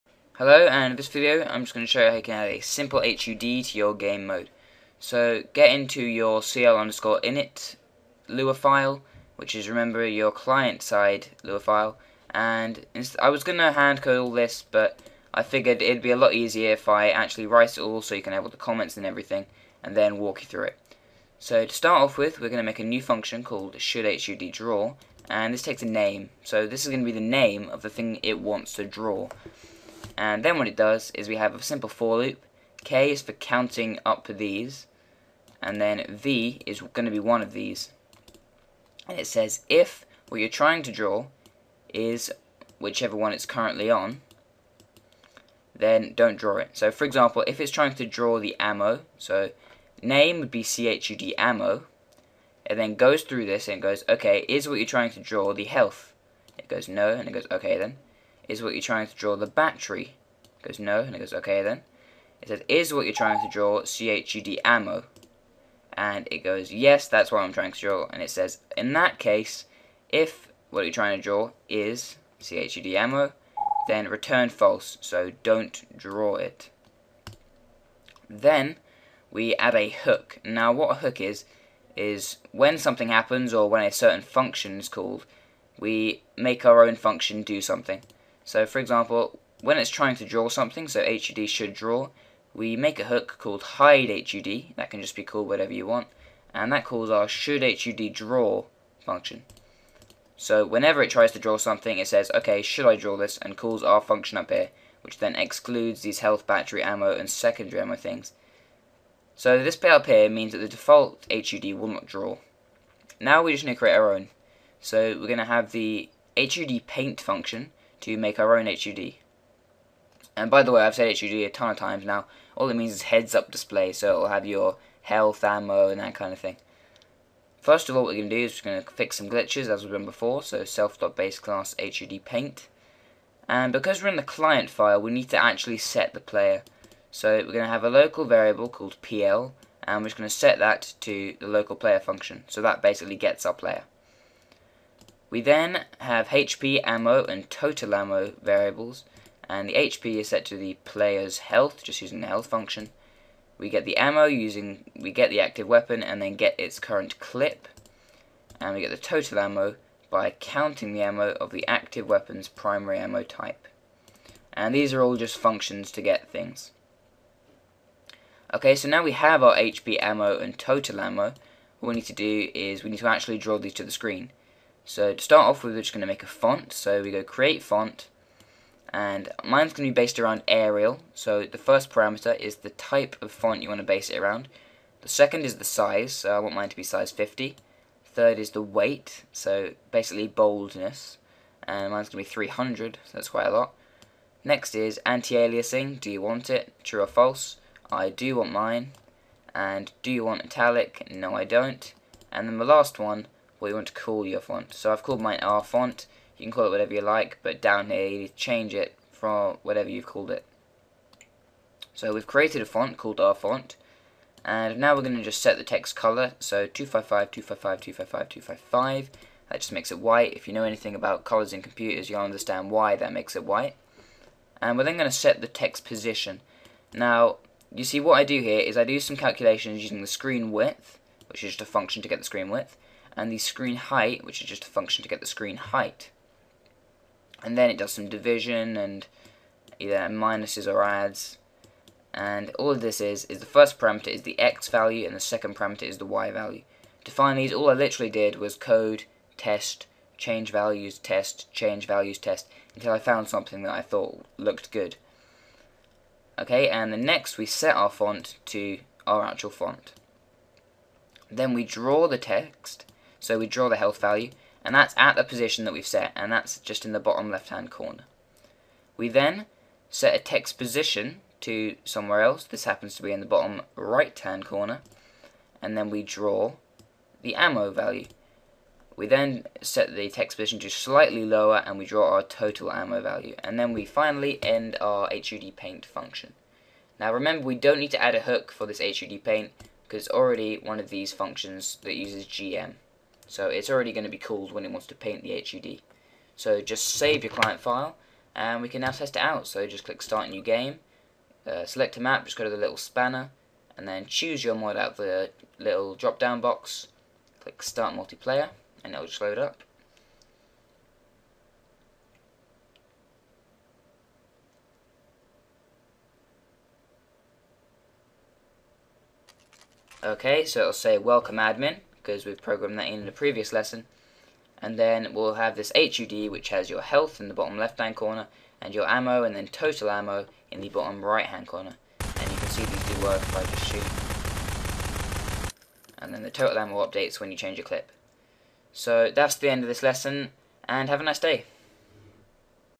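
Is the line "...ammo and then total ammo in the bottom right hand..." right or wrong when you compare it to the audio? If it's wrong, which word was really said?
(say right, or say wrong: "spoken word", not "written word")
right.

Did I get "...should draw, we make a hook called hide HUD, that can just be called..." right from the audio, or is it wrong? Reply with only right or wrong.
right.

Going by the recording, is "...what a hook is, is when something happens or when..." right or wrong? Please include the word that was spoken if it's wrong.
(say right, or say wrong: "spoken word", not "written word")
right.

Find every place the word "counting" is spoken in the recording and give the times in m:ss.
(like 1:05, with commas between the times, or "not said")
0:33, 2:40.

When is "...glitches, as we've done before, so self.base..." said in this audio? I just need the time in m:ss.
2:09.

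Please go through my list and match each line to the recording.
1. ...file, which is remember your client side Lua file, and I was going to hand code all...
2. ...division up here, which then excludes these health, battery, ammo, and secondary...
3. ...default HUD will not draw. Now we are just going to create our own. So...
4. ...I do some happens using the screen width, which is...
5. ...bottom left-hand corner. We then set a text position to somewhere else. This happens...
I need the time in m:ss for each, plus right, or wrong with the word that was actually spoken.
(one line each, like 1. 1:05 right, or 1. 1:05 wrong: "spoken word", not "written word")
1. 0:08 right
2. 1:44 wrong: "function", not "division"
3. 1:50 right
4. 3:48 wrong: "calculations", not "happens"
5. 4:26 right.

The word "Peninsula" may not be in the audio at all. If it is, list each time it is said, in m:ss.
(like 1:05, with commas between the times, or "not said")
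not said.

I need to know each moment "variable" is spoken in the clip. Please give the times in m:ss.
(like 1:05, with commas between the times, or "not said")
2:18, 2:28.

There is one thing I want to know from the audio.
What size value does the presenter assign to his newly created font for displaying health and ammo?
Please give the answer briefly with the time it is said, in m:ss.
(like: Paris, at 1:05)
50, at 3:07.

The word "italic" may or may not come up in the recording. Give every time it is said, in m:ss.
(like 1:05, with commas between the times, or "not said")
3:20.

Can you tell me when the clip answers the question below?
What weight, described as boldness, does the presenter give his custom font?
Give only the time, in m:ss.
3:12.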